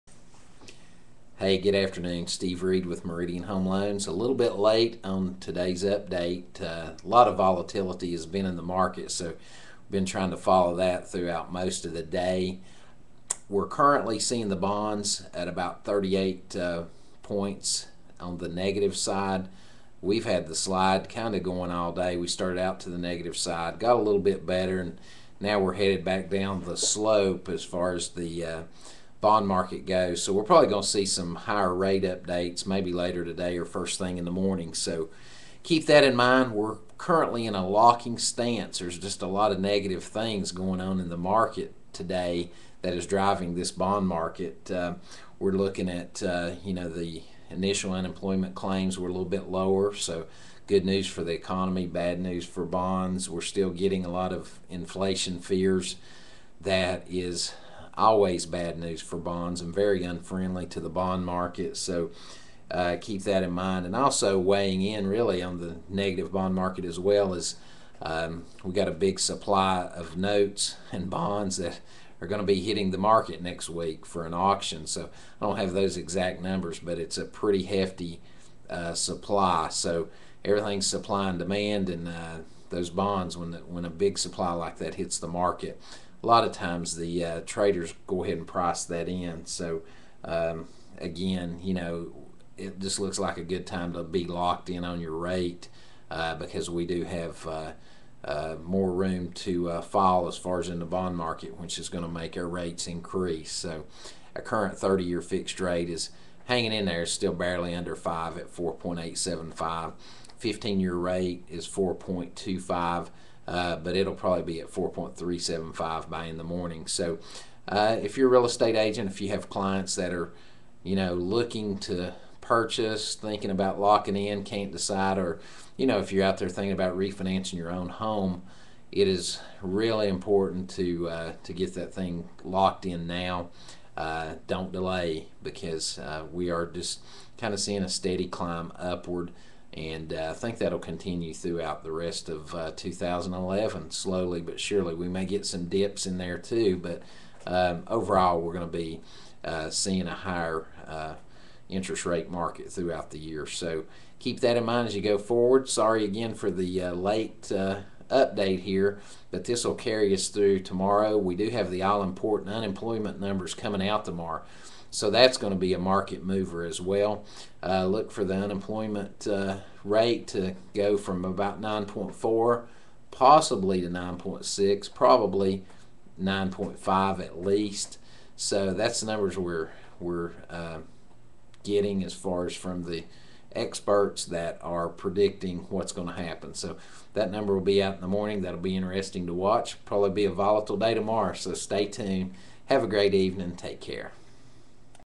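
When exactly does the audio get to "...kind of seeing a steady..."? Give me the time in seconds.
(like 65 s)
137 s.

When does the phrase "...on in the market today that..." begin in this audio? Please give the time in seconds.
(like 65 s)
40 s.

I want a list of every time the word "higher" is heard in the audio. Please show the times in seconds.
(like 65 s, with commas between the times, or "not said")
31 s, 150 s.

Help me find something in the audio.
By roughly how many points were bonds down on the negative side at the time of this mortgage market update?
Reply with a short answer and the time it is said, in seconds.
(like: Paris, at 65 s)
38, at 15 s.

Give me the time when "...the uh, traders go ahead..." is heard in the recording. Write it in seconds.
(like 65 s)
86 s.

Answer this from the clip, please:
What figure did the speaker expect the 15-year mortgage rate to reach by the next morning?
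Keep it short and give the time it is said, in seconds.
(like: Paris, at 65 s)
4.375, at 114 s.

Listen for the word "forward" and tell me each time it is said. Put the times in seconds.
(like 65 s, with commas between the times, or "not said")
155 s.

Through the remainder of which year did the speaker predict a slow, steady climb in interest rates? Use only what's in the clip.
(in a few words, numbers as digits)
2011.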